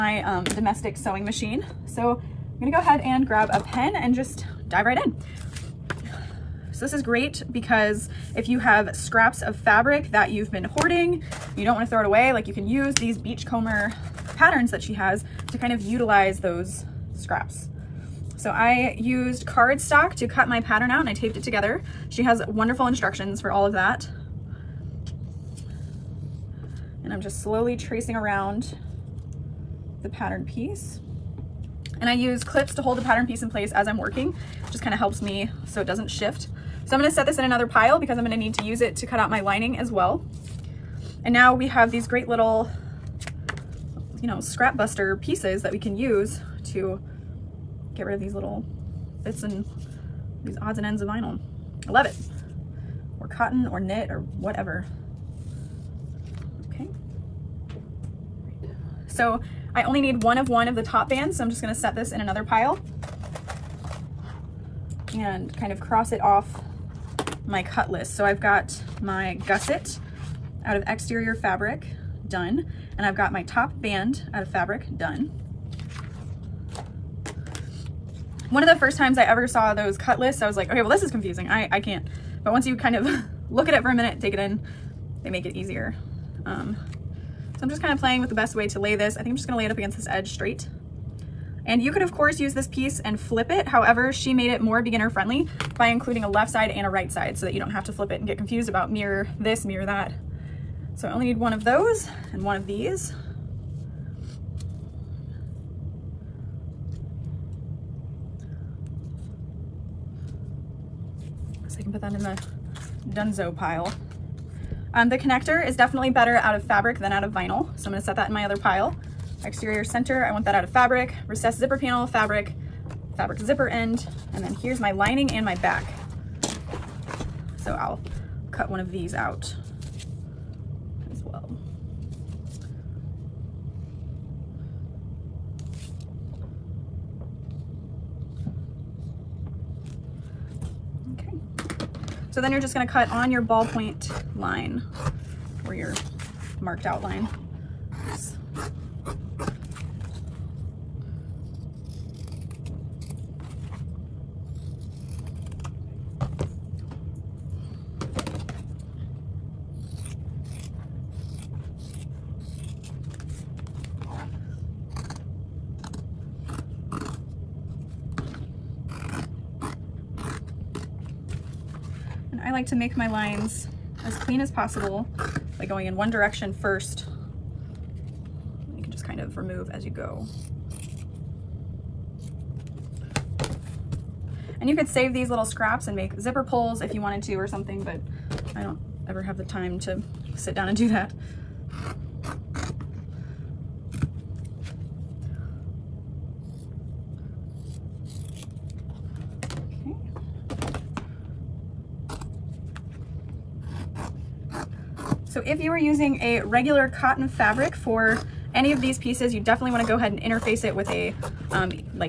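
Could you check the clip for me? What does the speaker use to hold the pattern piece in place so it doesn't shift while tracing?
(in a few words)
Clips.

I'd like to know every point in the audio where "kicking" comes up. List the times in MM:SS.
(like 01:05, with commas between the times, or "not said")
not said.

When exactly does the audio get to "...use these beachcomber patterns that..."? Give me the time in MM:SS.
00:12.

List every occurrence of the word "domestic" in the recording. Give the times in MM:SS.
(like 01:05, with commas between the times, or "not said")
00:00.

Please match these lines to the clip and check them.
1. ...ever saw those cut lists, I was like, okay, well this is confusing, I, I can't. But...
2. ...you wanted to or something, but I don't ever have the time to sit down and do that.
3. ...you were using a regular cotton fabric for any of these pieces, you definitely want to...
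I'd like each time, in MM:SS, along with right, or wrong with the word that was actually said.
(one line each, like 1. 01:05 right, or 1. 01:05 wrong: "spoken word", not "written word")
1. 01:19 right
2. 03:06 right
3. 03:25 right.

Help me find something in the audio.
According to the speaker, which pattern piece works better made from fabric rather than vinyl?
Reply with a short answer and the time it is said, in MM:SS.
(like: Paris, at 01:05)
The connector, at 01:55.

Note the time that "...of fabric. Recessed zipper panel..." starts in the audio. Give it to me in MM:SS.
02:00.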